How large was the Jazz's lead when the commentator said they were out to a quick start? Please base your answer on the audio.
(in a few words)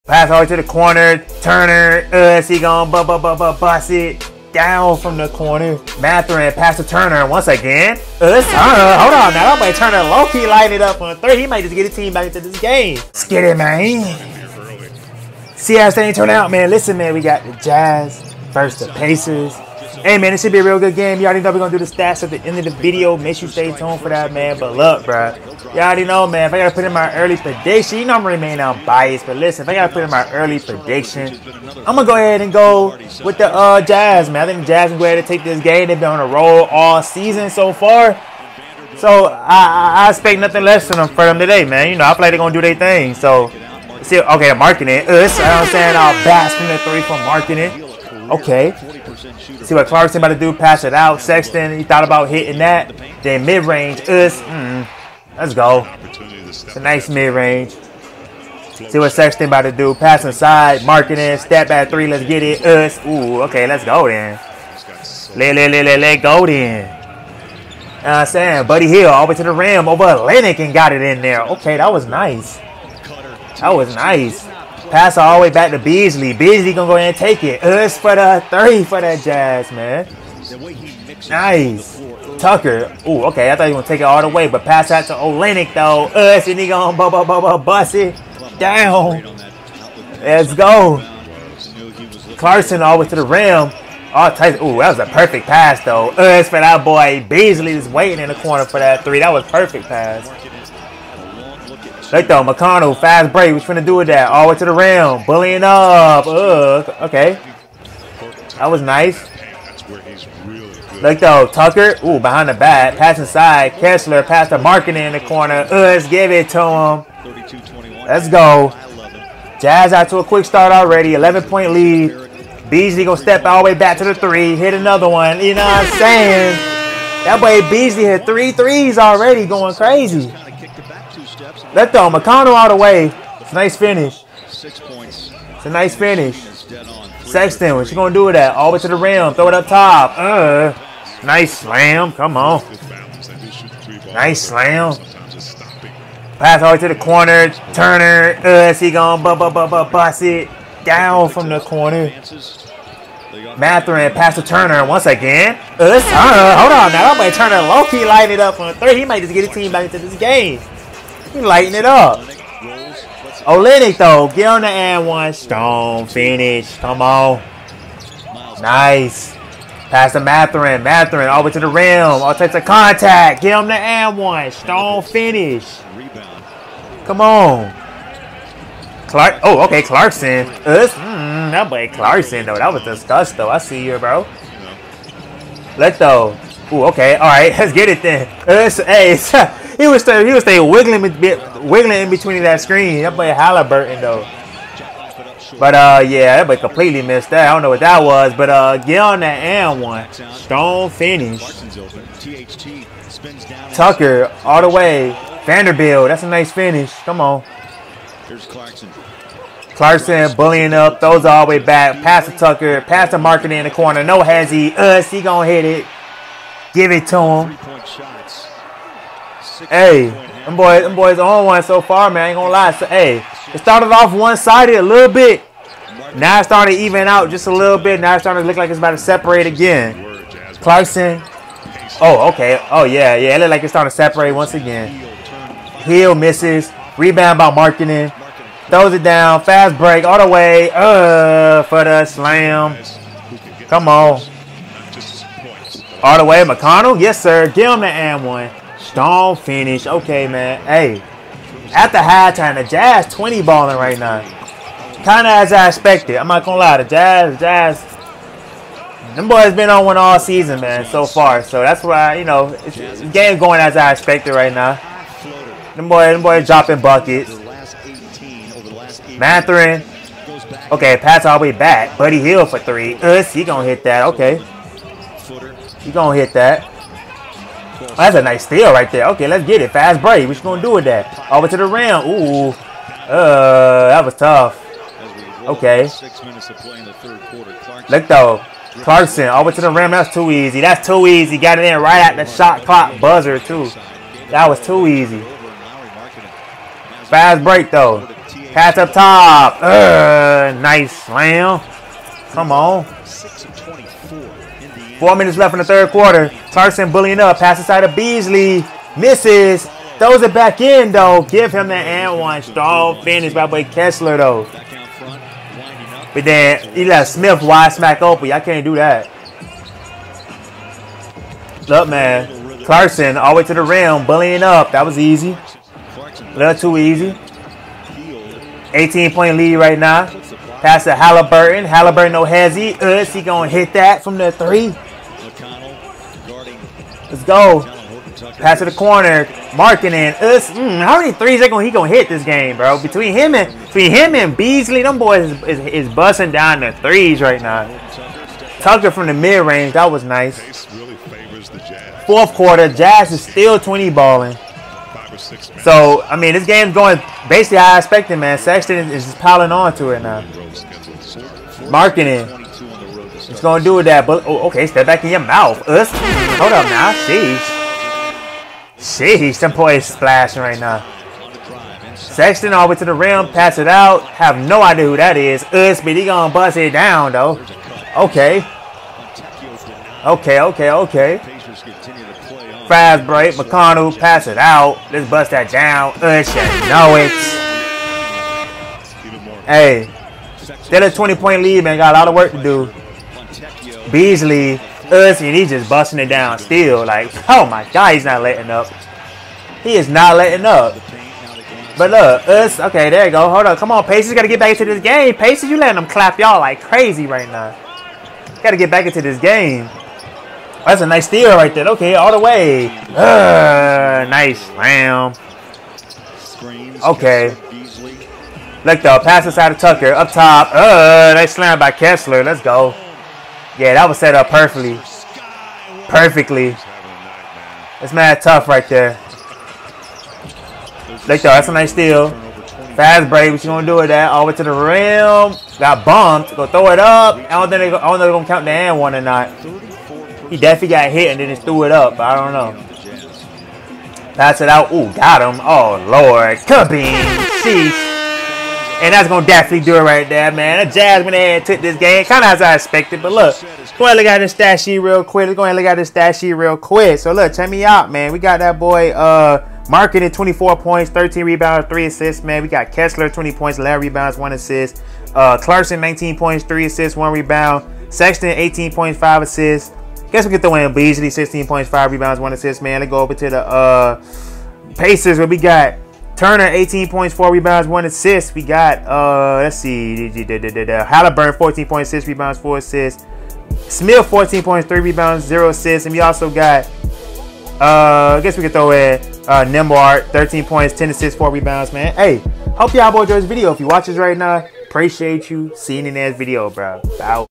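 11 points.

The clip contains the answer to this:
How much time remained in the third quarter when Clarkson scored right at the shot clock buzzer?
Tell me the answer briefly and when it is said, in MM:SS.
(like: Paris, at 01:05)
6 minutes, at 04:45.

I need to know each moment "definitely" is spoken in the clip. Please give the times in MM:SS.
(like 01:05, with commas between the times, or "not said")
07:20, 07:29.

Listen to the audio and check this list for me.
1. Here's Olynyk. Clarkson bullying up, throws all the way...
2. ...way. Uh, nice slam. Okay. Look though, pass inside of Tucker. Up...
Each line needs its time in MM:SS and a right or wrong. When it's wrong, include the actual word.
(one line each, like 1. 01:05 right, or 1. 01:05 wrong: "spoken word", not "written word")
1. 03:28 wrong: "Clarkson", not "Olynyk"
2. 06:52 right.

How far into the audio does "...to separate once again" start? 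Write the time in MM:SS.
03:53.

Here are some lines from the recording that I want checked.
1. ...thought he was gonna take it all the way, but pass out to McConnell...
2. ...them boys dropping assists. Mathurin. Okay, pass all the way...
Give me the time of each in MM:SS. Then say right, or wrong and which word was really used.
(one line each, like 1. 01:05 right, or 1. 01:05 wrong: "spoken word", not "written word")
1. 01:23 wrong: "Olynyk", not "McConnell"
2. 04:26 wrong: "buckets", not "assists".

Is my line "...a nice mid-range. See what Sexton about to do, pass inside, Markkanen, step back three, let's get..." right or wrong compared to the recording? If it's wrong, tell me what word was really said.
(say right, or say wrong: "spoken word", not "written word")
right.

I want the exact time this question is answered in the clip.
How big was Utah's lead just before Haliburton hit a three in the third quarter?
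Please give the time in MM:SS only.
05:28.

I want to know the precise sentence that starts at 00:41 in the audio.
You know, I feel like they're going to do their thing.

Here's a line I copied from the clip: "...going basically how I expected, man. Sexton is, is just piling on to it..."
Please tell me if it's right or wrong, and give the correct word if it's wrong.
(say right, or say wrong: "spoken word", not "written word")
right.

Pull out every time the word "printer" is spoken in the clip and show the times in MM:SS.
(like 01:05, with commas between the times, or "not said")
not said.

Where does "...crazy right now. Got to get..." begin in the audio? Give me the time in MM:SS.
06:46.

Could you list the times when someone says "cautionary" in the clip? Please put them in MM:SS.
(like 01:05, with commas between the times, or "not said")
not said.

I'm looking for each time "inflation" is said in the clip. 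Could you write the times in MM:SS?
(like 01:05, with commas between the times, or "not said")
not said.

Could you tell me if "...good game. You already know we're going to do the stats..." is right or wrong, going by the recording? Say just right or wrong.
right.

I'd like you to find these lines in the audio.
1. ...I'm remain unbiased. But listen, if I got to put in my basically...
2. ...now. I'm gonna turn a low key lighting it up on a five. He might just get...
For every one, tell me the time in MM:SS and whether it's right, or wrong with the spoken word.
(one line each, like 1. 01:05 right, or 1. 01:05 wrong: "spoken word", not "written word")
1. 00:28 wrong: "early", not "basically"
2. 02:36 wrong: "three", not "five".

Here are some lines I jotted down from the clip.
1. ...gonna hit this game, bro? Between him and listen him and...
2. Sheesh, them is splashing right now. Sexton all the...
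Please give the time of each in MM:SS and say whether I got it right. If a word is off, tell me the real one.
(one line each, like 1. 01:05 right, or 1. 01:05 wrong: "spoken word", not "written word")
1. 05:41 wrong: "between", not "listen"
2. 06:08 right.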